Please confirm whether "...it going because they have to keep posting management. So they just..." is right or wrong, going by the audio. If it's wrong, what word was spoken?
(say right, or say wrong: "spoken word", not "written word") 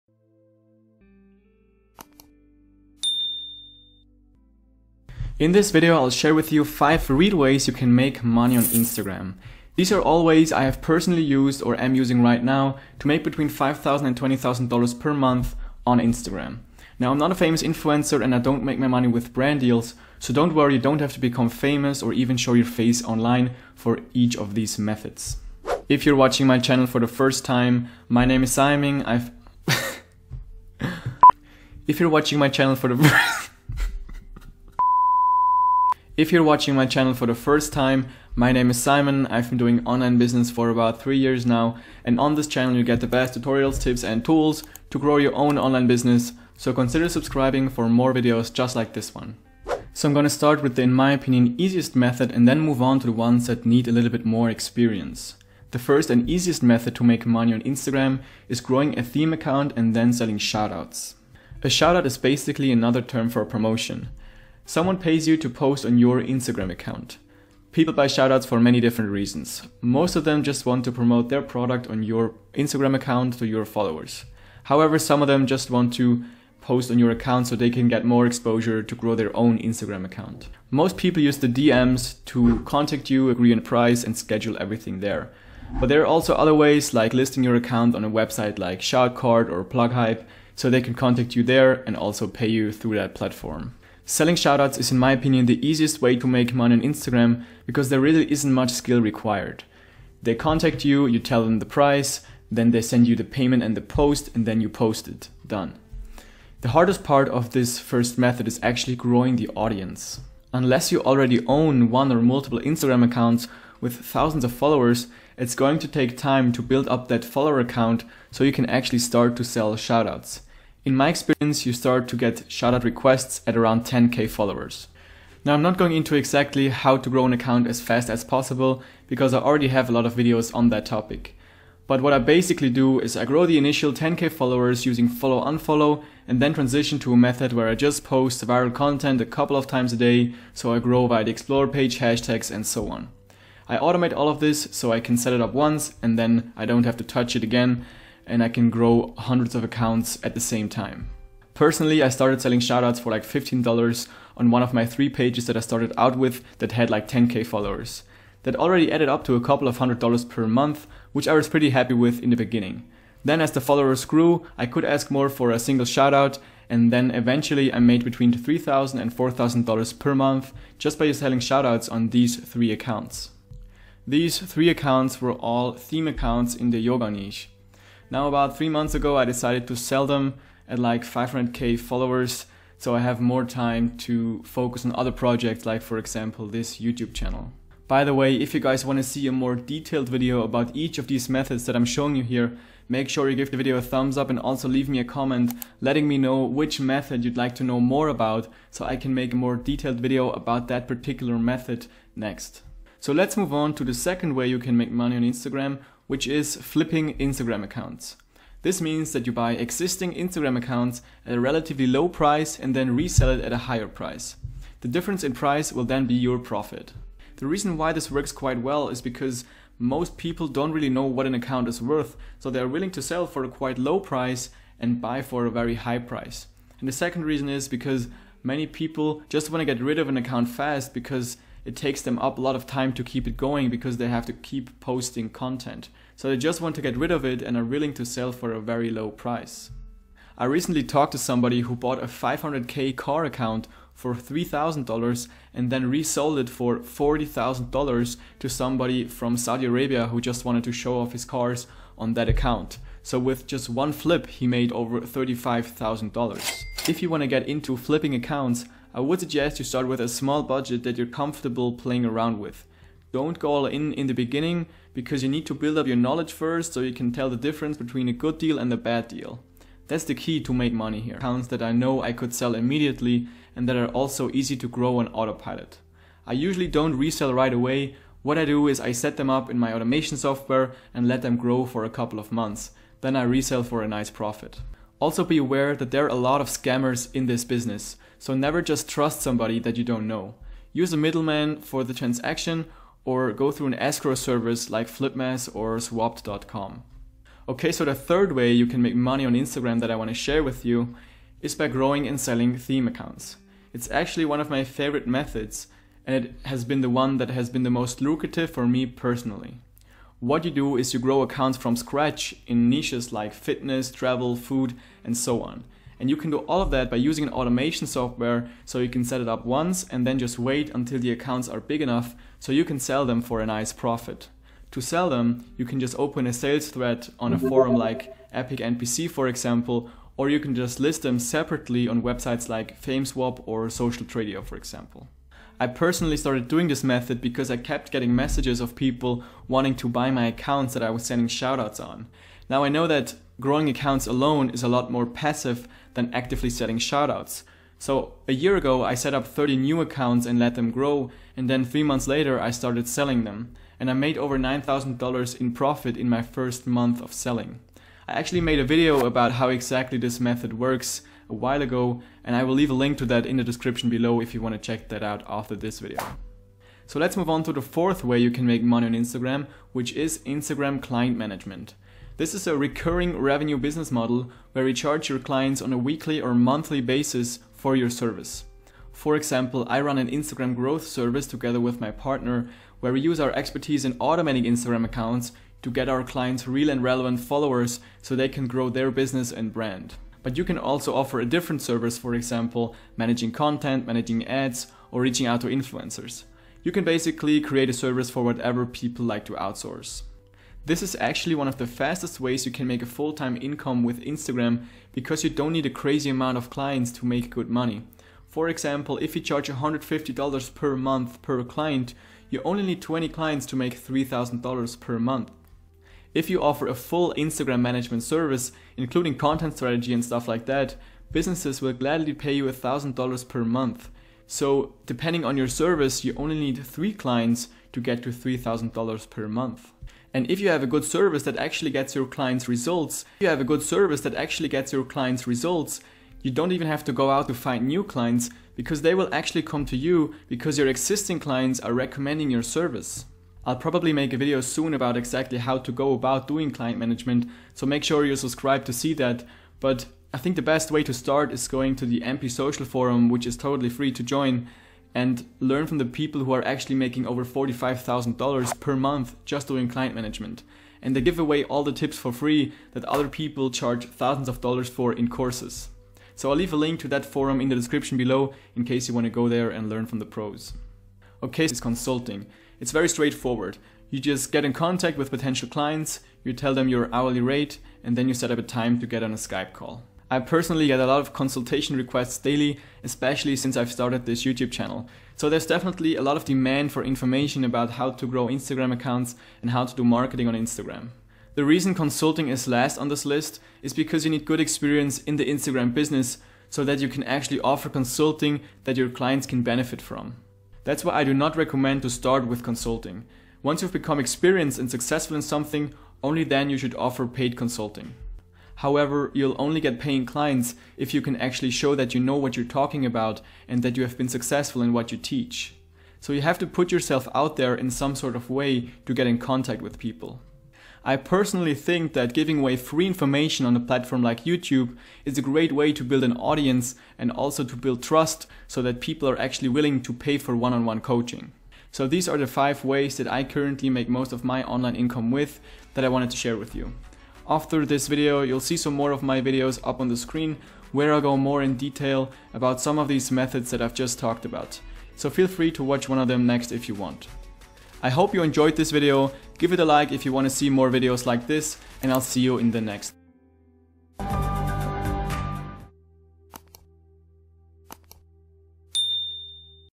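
wrong: "content", not "management".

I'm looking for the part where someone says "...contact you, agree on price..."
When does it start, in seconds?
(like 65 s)
82 s.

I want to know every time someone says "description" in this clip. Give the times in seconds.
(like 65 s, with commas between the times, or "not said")
363 s, 467 s.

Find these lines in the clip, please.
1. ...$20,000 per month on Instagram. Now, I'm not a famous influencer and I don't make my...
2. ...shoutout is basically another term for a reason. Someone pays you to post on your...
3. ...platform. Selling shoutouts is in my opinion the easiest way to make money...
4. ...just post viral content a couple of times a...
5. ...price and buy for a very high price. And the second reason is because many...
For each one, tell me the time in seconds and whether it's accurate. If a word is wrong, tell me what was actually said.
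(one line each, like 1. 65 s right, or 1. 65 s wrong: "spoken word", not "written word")
1. 14 s right
2. 61 s wrong: "promotion", not "reason"
3. 93 s right
4. 137 s right
5. 224 s right.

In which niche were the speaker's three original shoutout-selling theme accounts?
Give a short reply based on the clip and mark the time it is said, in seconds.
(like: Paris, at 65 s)
Yoga, at 176 s.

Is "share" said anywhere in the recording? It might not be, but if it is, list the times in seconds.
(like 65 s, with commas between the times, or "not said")
6 s, 300 s, 536 s.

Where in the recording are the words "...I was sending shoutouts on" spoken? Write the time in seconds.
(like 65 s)
340 s.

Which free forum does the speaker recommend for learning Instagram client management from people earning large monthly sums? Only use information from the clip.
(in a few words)
MP Social Forum.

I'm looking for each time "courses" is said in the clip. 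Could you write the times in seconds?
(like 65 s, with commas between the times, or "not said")
465 s.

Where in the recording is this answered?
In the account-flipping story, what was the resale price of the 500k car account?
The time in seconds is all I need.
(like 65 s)
246 s.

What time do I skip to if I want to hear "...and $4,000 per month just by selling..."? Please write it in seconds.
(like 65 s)
168 s.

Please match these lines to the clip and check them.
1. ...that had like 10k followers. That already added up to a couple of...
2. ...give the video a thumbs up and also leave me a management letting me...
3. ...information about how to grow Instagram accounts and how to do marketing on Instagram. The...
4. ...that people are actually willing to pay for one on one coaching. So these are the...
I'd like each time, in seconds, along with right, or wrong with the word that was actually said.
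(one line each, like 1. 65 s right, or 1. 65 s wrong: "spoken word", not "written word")
1. 156 s right
2. 193 s wrong: "comment", not "management"
3. 486 s right
4. 528 s right.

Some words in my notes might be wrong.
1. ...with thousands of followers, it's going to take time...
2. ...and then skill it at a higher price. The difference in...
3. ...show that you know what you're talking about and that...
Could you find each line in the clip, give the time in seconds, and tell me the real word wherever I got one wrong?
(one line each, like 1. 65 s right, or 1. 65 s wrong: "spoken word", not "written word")
1. 113 s right
2. 212 s wrong: "resell", not "skill"
3. 511 s right.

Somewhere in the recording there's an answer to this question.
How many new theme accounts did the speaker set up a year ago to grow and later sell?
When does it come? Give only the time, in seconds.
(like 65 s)
349 s.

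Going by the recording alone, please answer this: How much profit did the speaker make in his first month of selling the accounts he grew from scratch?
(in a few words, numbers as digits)
$9,000.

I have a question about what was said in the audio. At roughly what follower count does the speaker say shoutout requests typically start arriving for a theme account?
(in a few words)
10k.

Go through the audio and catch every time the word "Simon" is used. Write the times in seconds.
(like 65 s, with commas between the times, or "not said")
28 s, 38 s.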